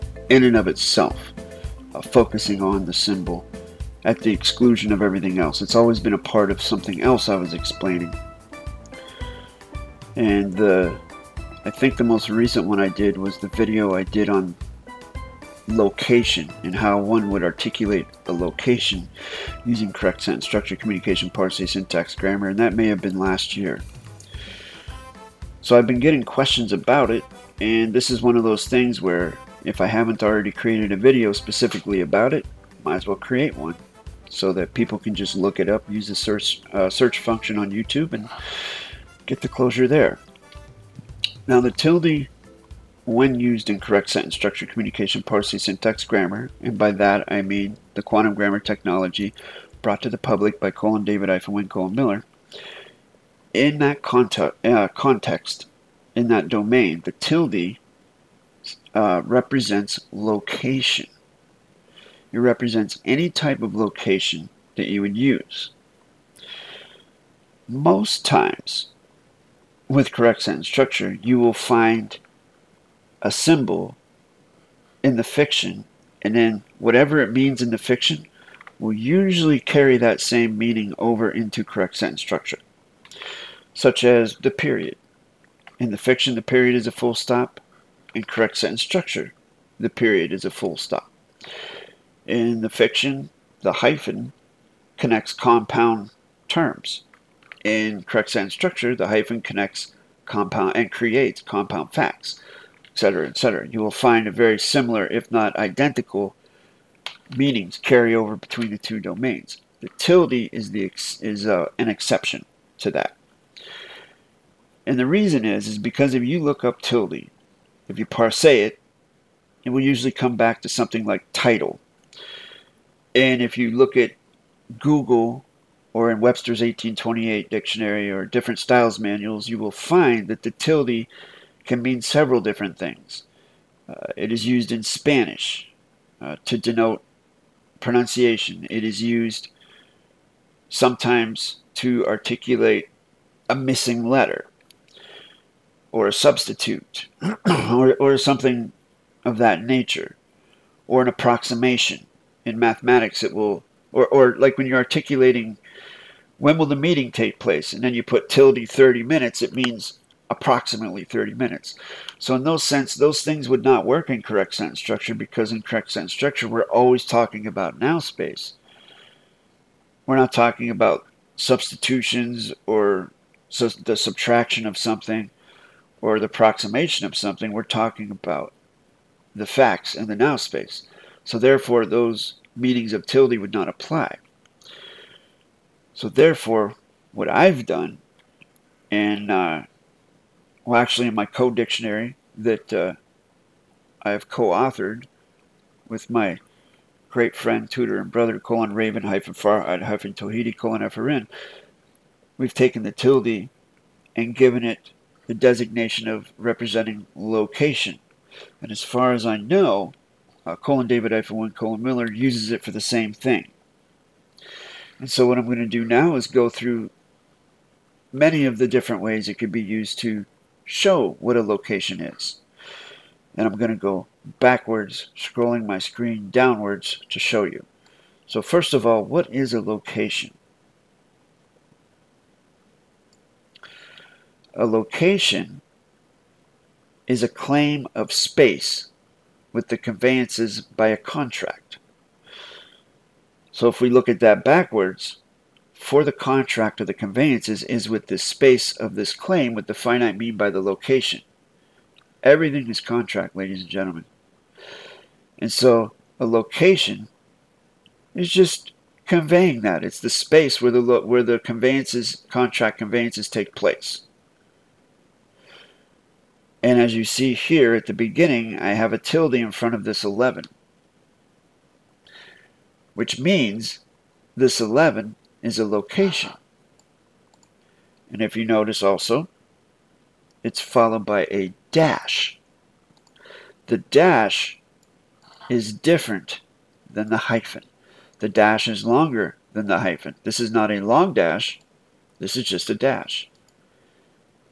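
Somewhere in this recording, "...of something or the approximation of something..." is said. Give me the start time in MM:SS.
02:54.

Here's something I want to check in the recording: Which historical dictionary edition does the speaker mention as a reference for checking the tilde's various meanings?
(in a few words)
Webster's 1828.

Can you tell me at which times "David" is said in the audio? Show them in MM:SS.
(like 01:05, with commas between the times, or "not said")
00:51, 03:30.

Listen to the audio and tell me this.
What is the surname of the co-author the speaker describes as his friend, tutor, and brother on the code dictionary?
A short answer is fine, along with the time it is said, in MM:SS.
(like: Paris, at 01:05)
Tohidi, at 03:20.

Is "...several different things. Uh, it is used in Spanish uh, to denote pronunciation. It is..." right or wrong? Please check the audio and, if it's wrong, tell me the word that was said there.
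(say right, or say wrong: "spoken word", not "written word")
right.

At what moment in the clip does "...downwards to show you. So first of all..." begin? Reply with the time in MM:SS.
03:46.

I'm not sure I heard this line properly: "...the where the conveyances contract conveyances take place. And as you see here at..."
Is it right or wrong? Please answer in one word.
right.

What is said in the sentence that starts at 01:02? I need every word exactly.
It represents any type of location that you would use.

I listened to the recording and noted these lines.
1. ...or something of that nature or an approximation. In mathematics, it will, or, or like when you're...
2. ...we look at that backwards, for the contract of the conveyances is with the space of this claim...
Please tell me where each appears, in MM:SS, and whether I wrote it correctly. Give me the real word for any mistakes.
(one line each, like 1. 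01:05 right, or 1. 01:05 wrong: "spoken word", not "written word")
1. 02:27 right
2. 04:03 right.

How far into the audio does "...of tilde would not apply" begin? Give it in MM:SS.
03:02.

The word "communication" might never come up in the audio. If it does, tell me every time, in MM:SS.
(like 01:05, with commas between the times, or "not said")
00:20, 00:44.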